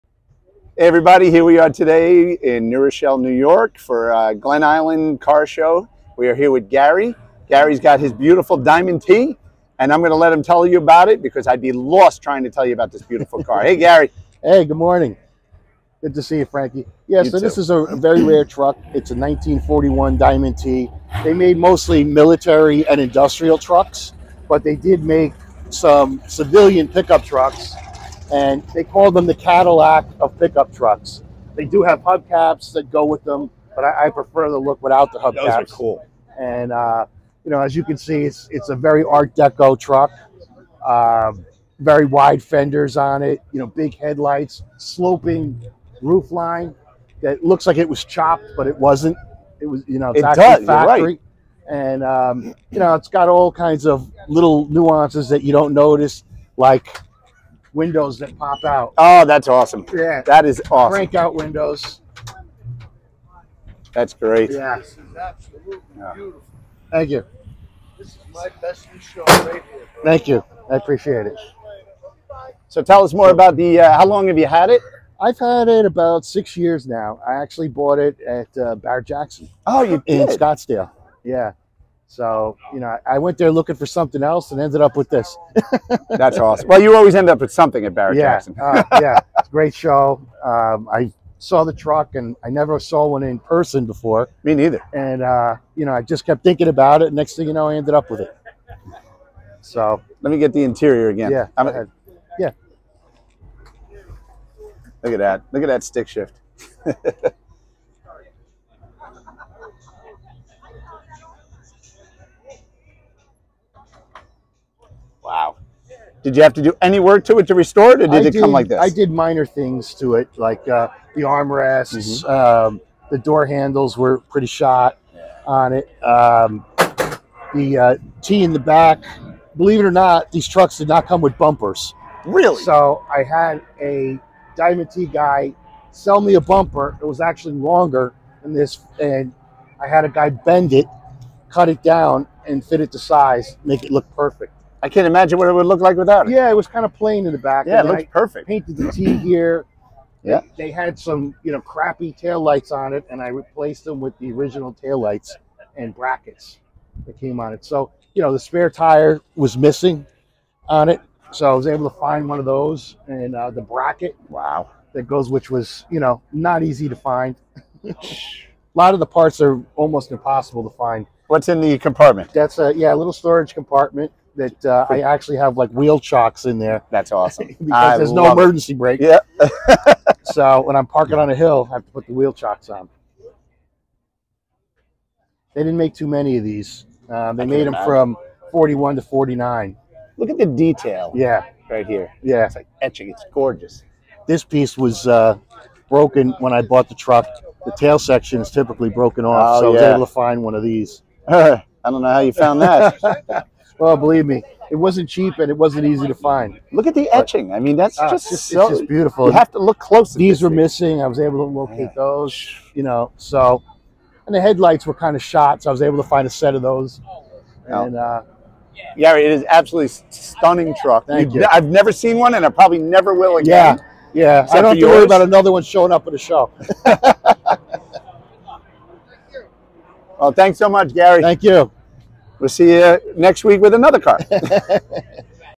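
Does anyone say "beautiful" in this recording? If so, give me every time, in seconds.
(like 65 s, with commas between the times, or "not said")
8 s, 13 s, 66 s, 208 s.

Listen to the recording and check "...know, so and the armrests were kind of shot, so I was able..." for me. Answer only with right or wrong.
wrong.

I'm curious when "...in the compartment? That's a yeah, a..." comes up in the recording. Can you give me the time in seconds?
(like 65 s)
171 s.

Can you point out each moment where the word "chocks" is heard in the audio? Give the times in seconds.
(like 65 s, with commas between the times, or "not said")
175 s, 182 s.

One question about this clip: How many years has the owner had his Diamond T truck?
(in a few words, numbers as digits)
About 6 years.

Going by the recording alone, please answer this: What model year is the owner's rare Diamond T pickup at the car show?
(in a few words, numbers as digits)
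1941.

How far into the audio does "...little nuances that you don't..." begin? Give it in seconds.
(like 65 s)
54 s.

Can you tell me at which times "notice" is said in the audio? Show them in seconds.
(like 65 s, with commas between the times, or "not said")
55 s.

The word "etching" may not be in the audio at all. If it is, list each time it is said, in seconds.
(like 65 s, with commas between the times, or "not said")
192 s, 207 s.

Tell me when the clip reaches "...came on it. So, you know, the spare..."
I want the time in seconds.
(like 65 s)
157 s.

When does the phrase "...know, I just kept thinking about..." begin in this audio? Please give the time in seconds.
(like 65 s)
95 s.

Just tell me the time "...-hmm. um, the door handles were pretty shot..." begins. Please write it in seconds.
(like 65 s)
122 s.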